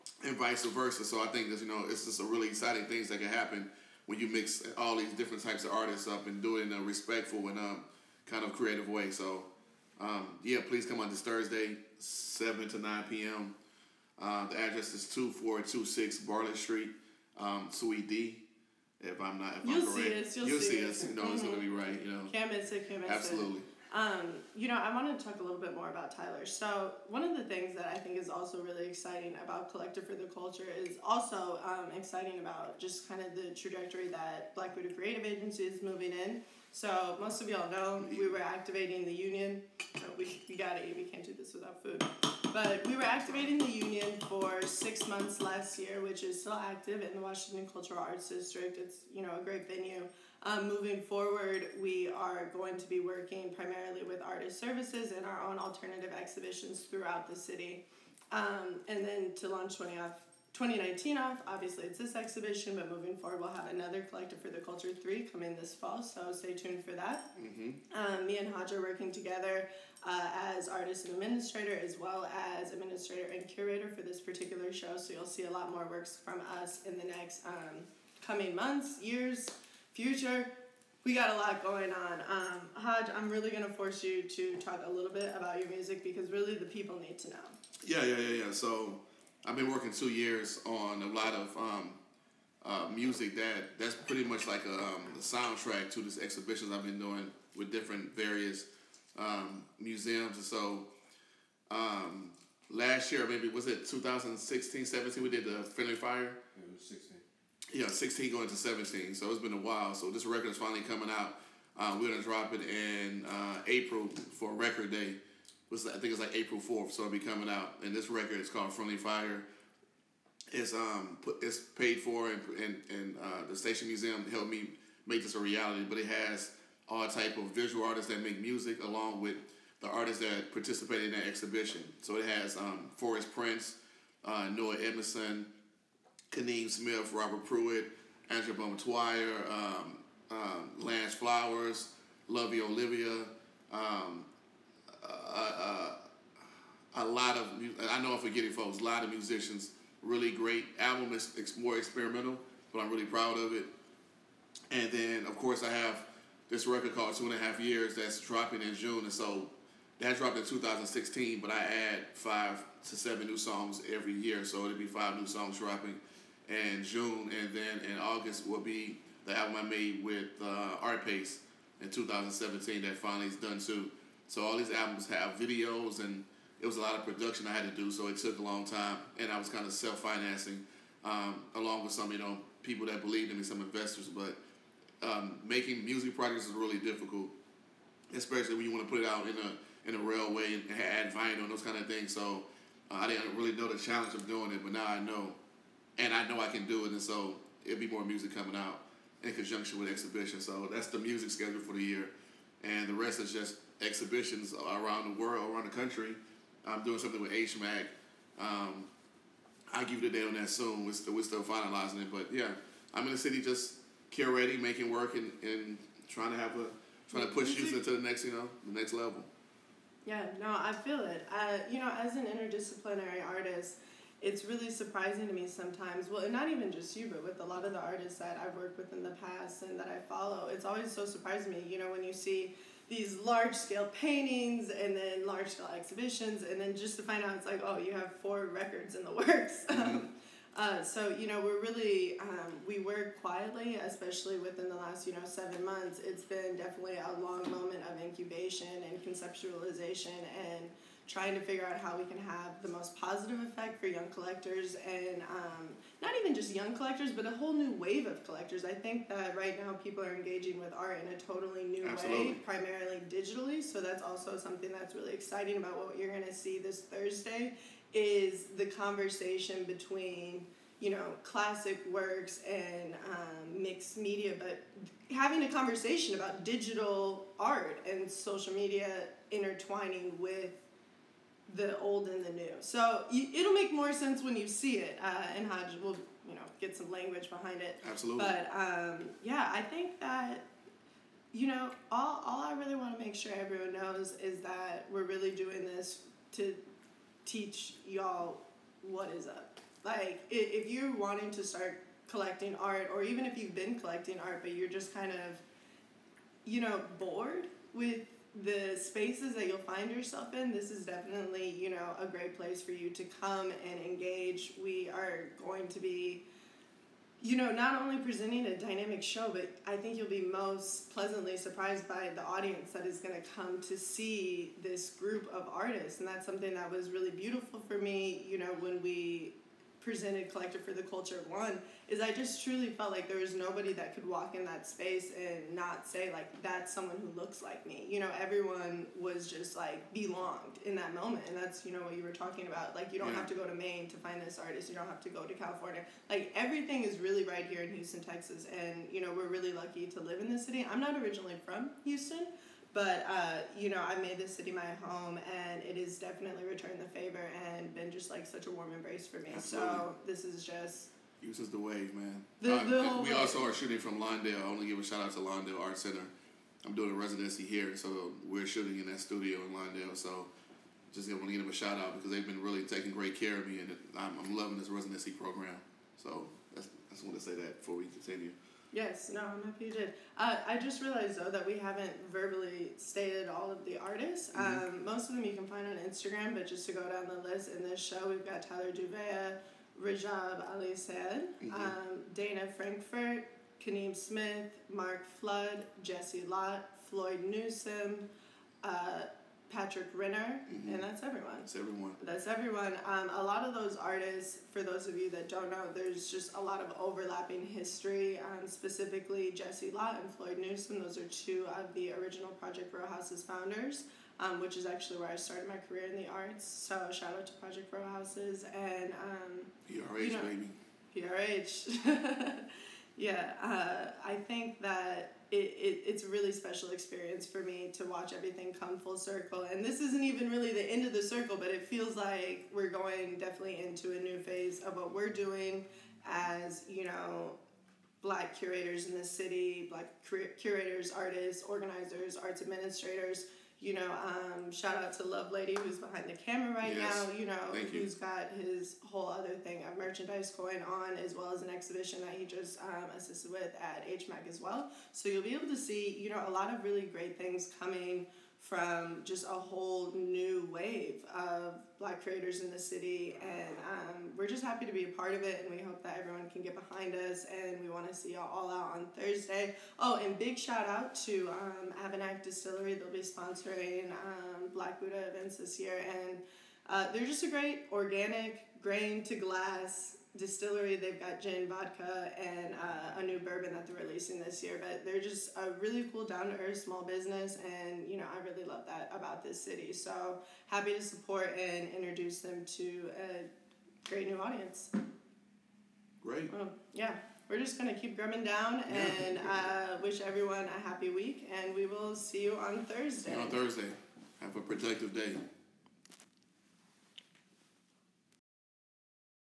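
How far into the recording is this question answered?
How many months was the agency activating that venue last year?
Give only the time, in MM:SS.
00:44.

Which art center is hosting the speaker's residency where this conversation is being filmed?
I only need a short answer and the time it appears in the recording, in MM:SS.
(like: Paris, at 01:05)
Lawndale Art Center, at 06:05.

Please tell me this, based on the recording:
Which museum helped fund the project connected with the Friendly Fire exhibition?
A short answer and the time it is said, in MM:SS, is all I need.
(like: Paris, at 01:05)
Station Museum, at 02:03.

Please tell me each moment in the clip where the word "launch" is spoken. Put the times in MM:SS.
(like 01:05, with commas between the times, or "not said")
00:59.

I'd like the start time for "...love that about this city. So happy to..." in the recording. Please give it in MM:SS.
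08:08.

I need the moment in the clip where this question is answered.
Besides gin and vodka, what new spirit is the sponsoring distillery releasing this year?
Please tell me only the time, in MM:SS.
08:03.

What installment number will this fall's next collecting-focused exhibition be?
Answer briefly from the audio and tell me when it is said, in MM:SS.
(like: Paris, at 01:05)
3, at 01:04.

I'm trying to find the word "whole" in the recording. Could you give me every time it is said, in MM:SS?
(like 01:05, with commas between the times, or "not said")
04:17, 07:28, 07:39.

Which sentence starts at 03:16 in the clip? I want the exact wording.
And so it'll be more music coming out in conjunction with exhibition.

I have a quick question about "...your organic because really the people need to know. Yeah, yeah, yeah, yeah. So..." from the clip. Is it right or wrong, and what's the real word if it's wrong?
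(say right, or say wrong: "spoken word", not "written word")
wrong: "music", not "organic".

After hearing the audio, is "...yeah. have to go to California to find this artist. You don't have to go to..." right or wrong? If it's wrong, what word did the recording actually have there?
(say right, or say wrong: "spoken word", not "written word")
wrong: "Maine", not "California".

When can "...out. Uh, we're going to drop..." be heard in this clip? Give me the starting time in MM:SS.
01:51.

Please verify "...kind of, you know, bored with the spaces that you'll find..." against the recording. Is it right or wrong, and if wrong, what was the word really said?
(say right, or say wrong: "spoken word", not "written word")
right.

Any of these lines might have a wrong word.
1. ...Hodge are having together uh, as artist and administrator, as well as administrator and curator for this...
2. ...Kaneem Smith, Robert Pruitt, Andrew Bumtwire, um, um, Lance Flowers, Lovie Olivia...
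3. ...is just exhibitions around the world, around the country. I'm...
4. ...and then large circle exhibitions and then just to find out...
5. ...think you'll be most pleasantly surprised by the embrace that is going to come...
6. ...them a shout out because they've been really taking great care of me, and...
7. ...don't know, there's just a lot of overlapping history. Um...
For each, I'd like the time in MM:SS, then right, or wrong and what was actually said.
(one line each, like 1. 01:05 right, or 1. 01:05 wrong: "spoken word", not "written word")
1. 01:08 wrong: "working", not "having"
2. 02:16 right
3. 03:23 right
4. 03:54 wrong: "scale", not "circle"
5. 05:19 wrong: "audience", not "embrace"
6. 06:11 right
7. 06:45 right.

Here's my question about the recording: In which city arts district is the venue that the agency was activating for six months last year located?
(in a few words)
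Washington Cultural Arts District.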